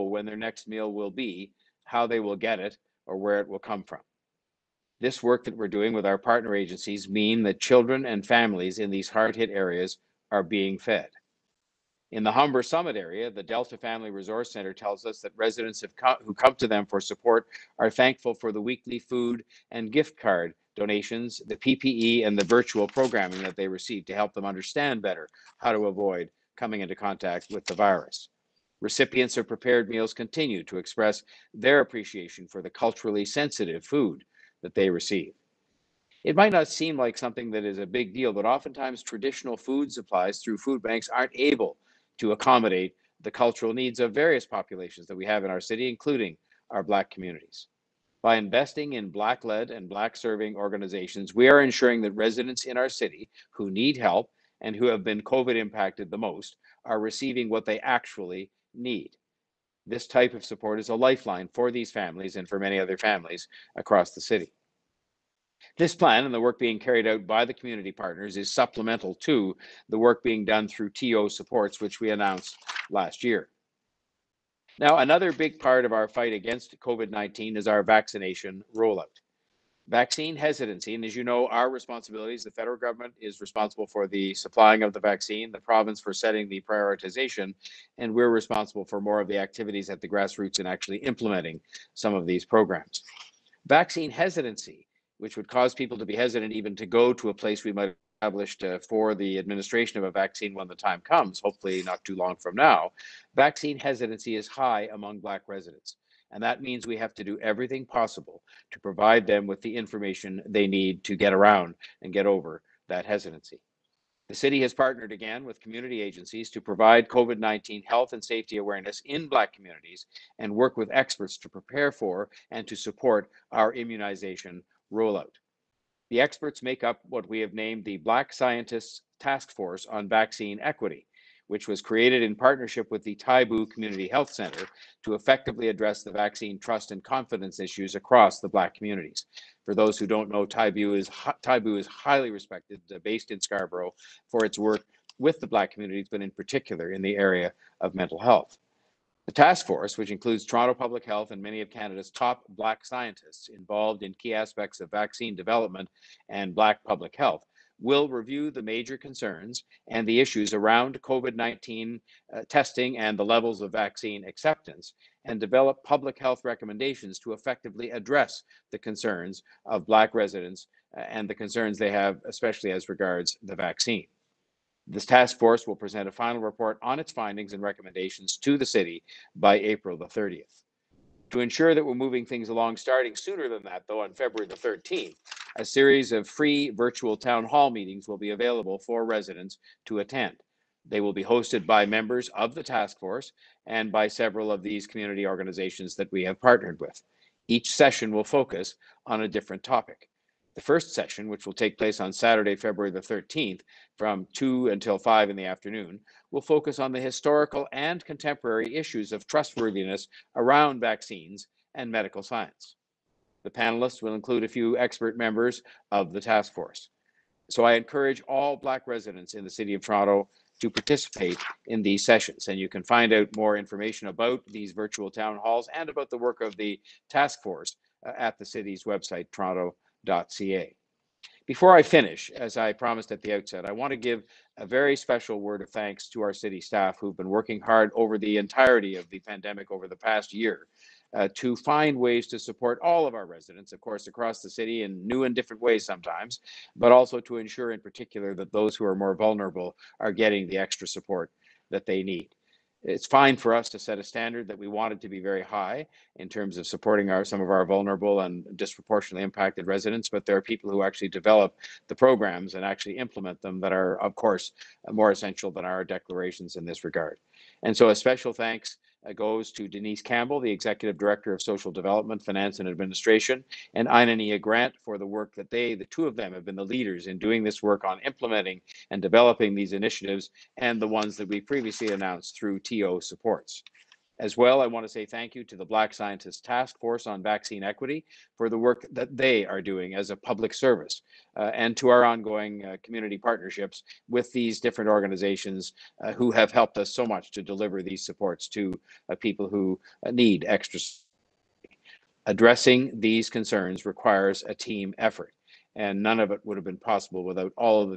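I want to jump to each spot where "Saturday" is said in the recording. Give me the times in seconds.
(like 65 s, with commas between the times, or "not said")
202 s.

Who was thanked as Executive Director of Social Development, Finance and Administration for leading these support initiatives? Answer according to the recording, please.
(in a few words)
Denise Campbell.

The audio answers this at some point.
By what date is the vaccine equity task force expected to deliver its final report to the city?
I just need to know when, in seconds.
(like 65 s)
179 s.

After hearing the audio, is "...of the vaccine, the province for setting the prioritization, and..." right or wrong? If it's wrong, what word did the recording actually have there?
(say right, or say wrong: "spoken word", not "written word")
right.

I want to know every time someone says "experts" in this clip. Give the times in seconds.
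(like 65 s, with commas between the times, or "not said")
120 s, 126 s, 214 s.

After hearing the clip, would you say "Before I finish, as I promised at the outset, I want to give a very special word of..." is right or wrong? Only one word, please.
right.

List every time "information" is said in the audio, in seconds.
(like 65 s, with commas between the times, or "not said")
109 s, 223 s.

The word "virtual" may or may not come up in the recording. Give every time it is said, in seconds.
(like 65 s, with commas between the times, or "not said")
22 s, 186 s, 224 s.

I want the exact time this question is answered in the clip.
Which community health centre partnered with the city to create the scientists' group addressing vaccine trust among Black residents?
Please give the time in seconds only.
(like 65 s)
133 s.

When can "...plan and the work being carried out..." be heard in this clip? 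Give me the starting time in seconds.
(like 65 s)
65 s.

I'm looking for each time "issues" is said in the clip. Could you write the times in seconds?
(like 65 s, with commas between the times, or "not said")
137 s, 160 s, 208 s.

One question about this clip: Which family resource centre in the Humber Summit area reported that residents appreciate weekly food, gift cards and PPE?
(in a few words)
Delta Family Resource Center.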